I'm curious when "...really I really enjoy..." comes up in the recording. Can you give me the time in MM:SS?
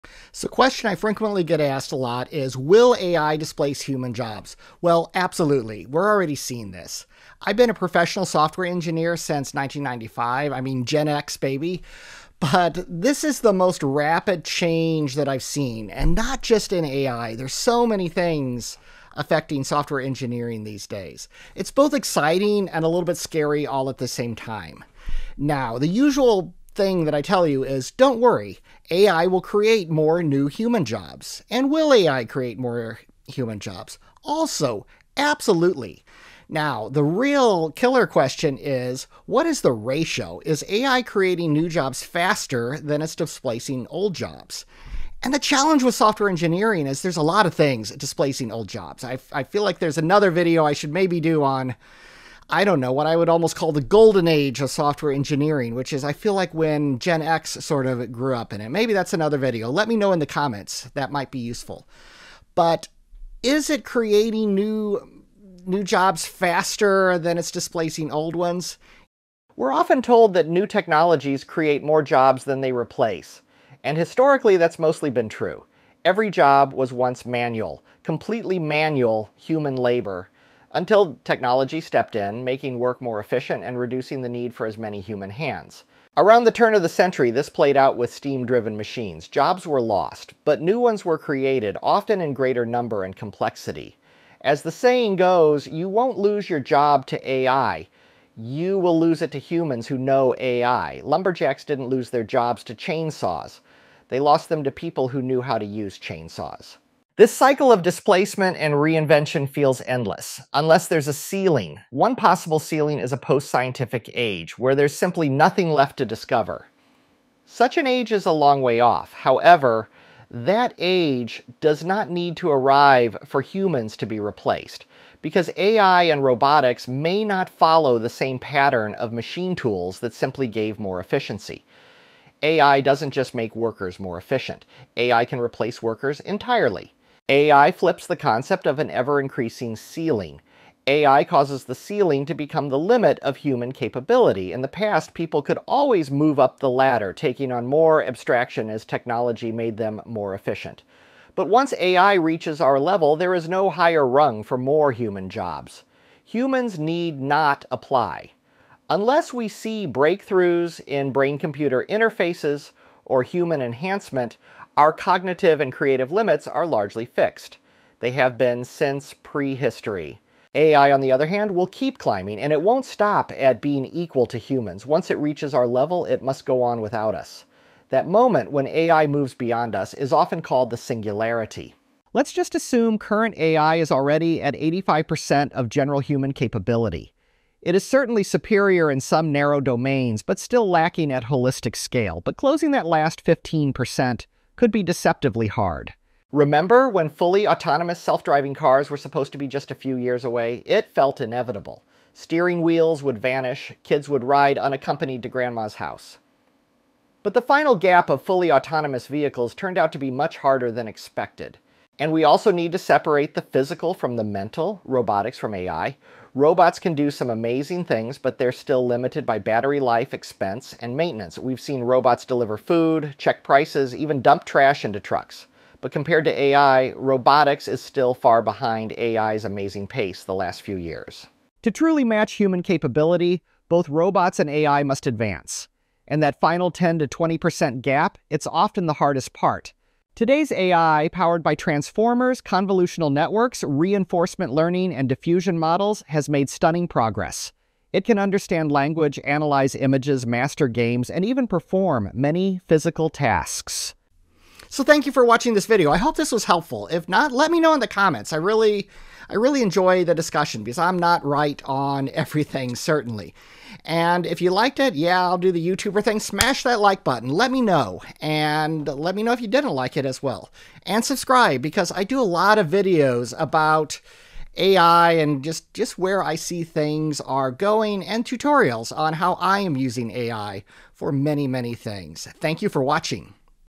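04:18.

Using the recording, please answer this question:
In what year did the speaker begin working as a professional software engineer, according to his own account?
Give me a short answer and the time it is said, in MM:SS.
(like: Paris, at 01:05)
1995, at 00:09.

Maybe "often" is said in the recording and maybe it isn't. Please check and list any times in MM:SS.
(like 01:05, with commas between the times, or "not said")
01:09, 01:31, 03:00, 03:58.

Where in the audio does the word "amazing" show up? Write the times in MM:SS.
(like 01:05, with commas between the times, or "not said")
03:37, 03:49.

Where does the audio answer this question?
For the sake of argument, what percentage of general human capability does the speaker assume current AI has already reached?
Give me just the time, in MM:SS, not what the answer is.
03:04.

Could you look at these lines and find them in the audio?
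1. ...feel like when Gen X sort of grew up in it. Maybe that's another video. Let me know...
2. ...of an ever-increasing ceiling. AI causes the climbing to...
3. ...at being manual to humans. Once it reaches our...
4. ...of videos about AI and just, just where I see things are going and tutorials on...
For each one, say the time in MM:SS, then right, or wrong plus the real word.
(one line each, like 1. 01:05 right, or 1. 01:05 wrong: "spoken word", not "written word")
1. 00:56 right
2. 02:18 wrong: "ceiling", not "climbing"
3. 02:53 wrong: "equal", not "manual"
4. 04:32 right.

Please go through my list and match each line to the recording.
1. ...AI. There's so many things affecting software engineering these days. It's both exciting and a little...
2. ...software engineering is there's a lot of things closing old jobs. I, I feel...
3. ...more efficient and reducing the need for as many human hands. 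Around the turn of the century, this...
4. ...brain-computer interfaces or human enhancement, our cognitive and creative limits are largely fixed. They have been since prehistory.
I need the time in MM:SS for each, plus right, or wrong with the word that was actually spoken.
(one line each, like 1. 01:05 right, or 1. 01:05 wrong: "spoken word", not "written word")
1. 00:16 right
2. 00:45 wrong: "displacing", not "closing"
3. 01:23 right
4. 02:41 right.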